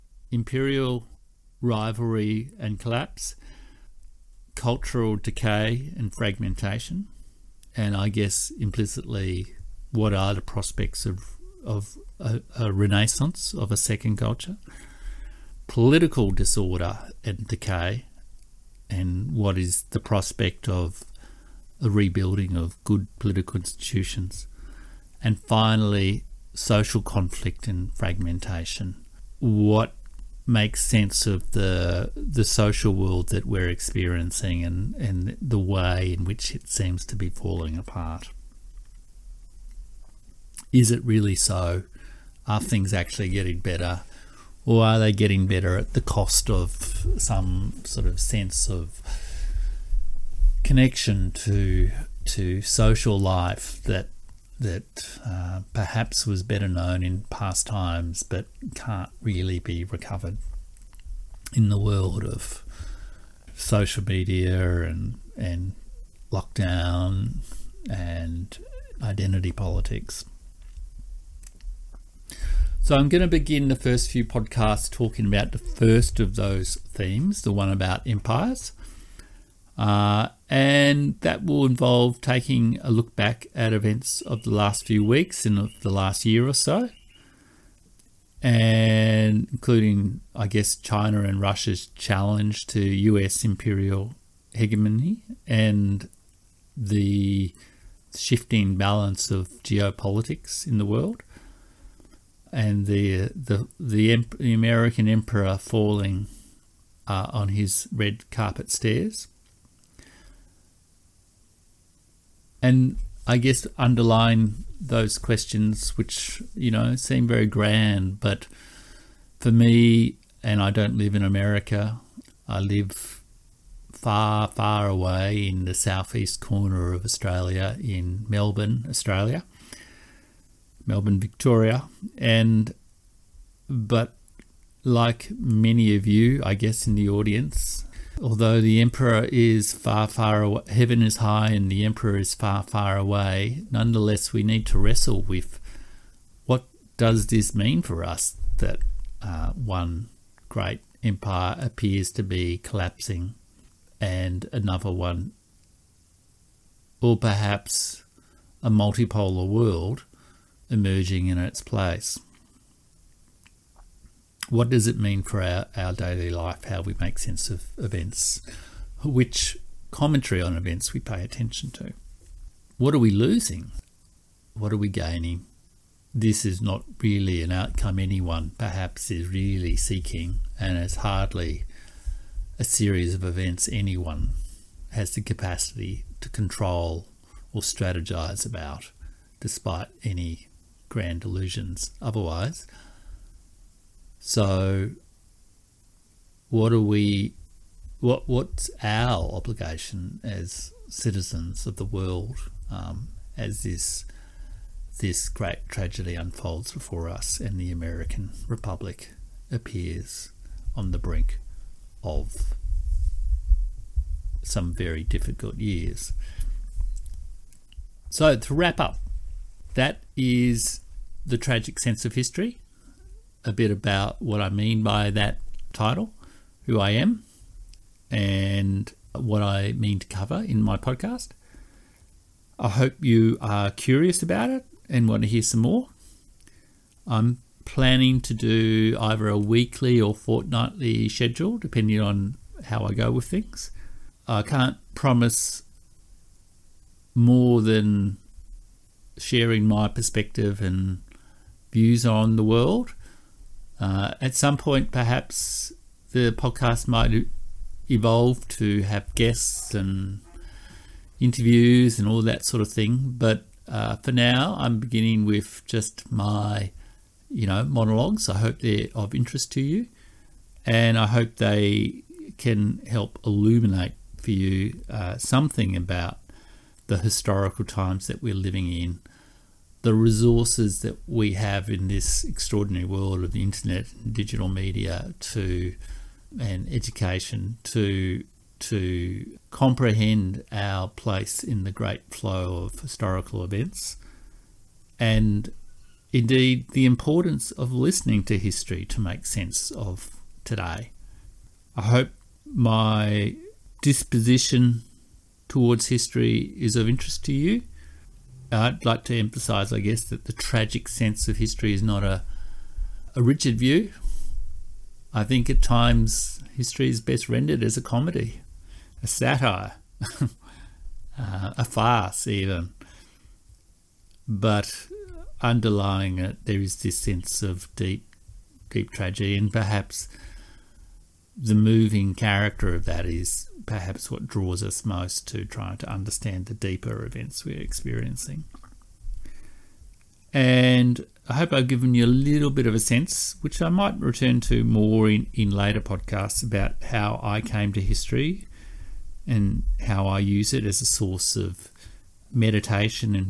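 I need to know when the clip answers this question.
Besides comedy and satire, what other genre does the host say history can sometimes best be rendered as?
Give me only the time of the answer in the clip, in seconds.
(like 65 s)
321 s.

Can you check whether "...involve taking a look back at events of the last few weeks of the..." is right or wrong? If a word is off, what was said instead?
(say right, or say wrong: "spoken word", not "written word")
right.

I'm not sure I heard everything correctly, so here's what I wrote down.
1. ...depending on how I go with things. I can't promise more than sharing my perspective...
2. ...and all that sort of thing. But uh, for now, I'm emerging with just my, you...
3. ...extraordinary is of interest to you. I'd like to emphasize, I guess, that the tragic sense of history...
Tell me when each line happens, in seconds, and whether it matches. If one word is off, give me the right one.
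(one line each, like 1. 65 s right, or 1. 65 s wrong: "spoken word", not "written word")
1. 241 s right
2. 261 s wrong: "beginning", not "emerging"
3. 305 s wrong: "history", not "extraordinary".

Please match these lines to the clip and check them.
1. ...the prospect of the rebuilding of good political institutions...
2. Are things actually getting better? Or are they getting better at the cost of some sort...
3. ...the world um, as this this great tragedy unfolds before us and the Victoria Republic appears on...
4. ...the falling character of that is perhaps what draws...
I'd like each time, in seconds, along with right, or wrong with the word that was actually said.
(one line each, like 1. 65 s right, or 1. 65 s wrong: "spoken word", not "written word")
1. 19 s right
2. 42 s right
3. 201 s wrong: "American", not "Victoria"
4. 331 s wrong: "moving", not "falling".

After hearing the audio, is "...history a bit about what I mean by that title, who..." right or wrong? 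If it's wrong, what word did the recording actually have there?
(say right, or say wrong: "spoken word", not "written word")
right.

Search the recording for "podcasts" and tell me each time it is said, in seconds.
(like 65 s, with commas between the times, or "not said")
74 s, 230 s, 256 s, 345 s.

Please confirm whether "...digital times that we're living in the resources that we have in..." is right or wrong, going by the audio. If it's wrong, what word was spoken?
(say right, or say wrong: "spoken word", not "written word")
wrong: "historical", not "digital".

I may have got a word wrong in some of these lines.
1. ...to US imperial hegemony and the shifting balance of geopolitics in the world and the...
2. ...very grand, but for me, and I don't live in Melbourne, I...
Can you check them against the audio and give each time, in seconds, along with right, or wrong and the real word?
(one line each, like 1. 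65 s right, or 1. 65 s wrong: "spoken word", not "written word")
1. 92 s right
2. 117 s wrong: "America", not "Melbourne".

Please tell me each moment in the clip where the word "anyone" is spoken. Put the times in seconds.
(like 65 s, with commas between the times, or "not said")
177 s, 183 s.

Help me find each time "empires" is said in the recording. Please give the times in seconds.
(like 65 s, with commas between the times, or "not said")
78 s, 151 s.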